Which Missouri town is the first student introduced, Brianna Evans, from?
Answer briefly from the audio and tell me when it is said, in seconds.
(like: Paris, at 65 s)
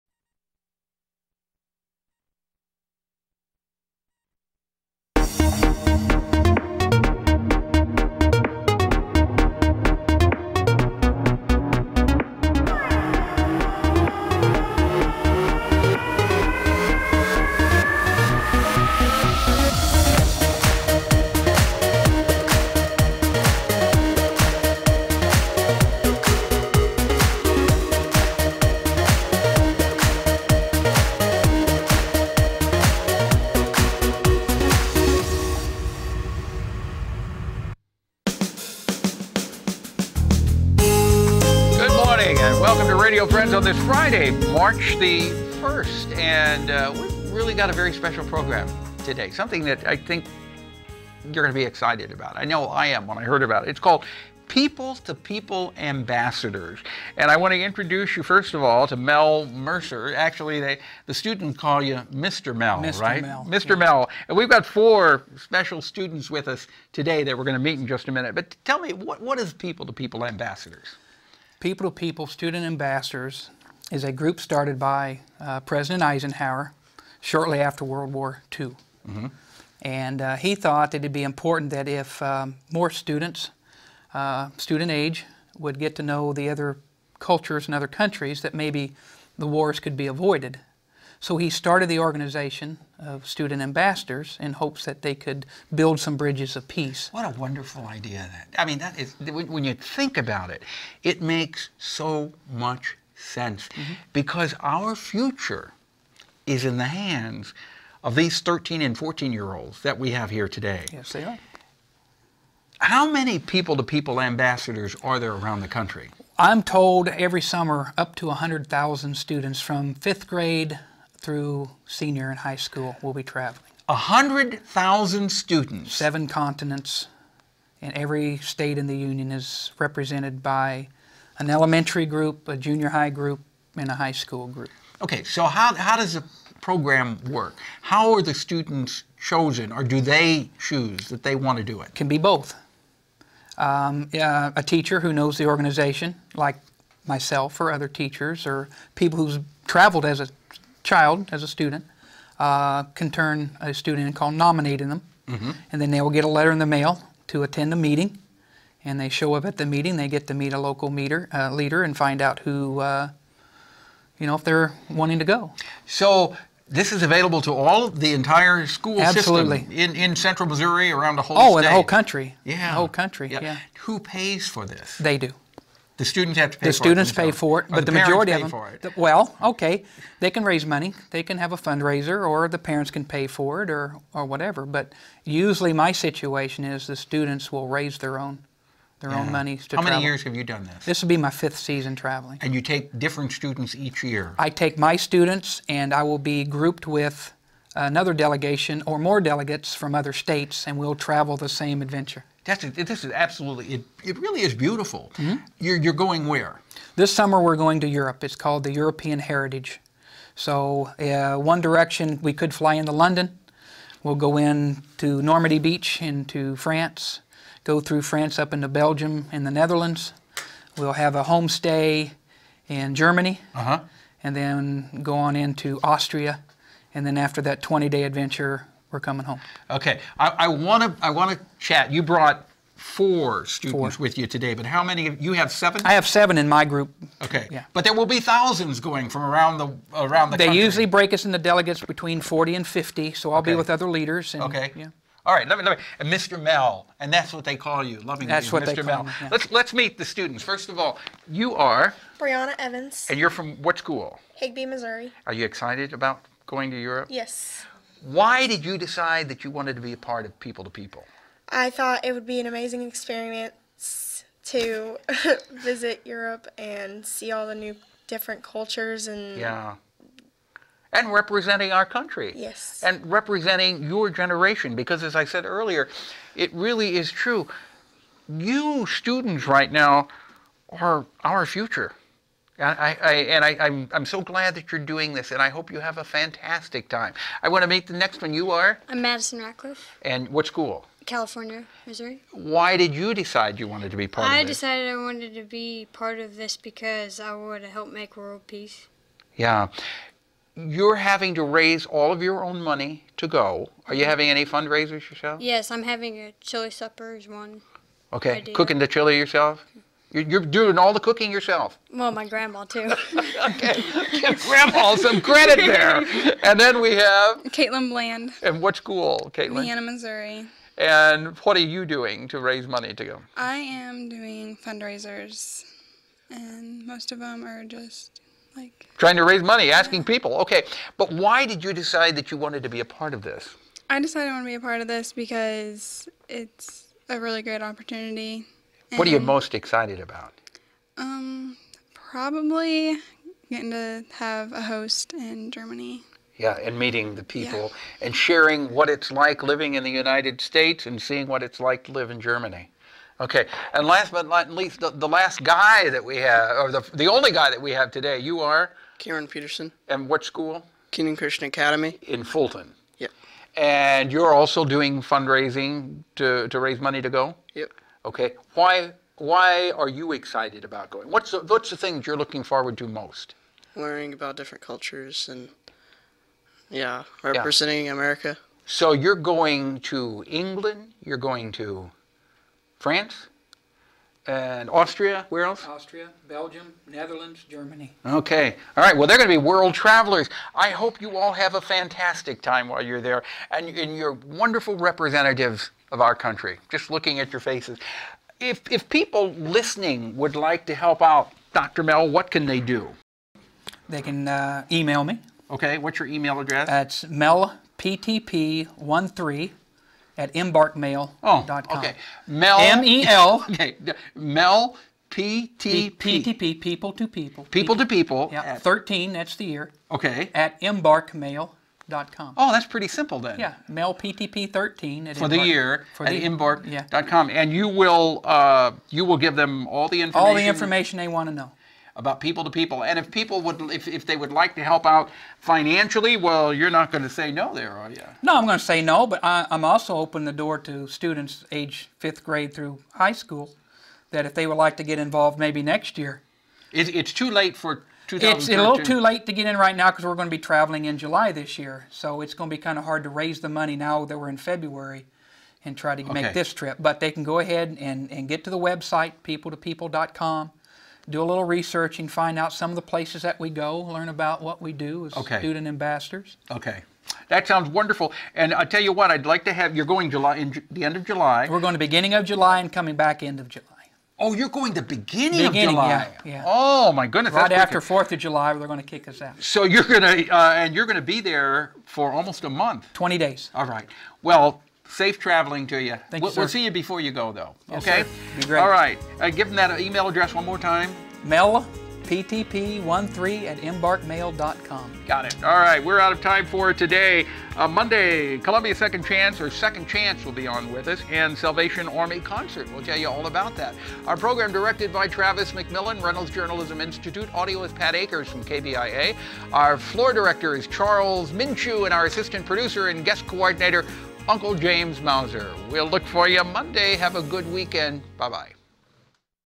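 Higbee, at 254 s.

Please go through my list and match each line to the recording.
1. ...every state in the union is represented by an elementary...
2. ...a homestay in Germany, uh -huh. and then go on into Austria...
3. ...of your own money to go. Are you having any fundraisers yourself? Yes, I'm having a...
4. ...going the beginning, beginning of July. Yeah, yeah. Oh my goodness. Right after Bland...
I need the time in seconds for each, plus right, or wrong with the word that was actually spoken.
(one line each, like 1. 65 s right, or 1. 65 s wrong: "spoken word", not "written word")
1. 127 s right
2. 221 s right
3. 302 s right
4. 474 s wrong: "Fourth", not "Bland".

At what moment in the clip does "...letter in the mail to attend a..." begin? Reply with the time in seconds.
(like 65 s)
156 s.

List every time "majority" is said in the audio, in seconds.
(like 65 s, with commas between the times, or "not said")
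177 s.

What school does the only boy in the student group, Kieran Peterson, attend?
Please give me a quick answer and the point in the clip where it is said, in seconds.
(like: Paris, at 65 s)
Kingdom Christian Academy, at 360 s.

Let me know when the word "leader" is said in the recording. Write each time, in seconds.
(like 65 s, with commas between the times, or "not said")
161 s, 243 s.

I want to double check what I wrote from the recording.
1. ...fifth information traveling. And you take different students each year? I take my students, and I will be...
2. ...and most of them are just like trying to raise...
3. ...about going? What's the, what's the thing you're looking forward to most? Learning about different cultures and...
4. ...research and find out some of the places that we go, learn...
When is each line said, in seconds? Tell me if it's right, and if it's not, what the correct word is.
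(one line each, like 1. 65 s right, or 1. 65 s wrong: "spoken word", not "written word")
1. 191 s wrong: "season", not "information"
2. 326 s right
3. 370 s right
4. 461 s right.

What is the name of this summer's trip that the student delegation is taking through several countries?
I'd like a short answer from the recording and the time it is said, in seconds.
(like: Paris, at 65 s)
European Heritage, at 208 s.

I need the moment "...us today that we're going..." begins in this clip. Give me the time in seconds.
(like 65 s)
66 s.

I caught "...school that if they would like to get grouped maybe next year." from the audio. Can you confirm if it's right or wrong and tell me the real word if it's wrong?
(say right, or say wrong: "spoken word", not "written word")
wrong: "involved", not "grouped".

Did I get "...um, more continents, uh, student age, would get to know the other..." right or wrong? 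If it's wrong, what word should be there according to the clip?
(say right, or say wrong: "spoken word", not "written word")
wrong: "students", not "continents".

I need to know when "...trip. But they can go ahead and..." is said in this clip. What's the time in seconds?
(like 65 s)
456 s.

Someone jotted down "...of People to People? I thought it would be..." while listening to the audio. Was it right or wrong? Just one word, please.
right.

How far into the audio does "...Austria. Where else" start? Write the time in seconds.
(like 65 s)
384 s.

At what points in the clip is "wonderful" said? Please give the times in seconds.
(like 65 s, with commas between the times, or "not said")
97 s, 394 s, 467 s.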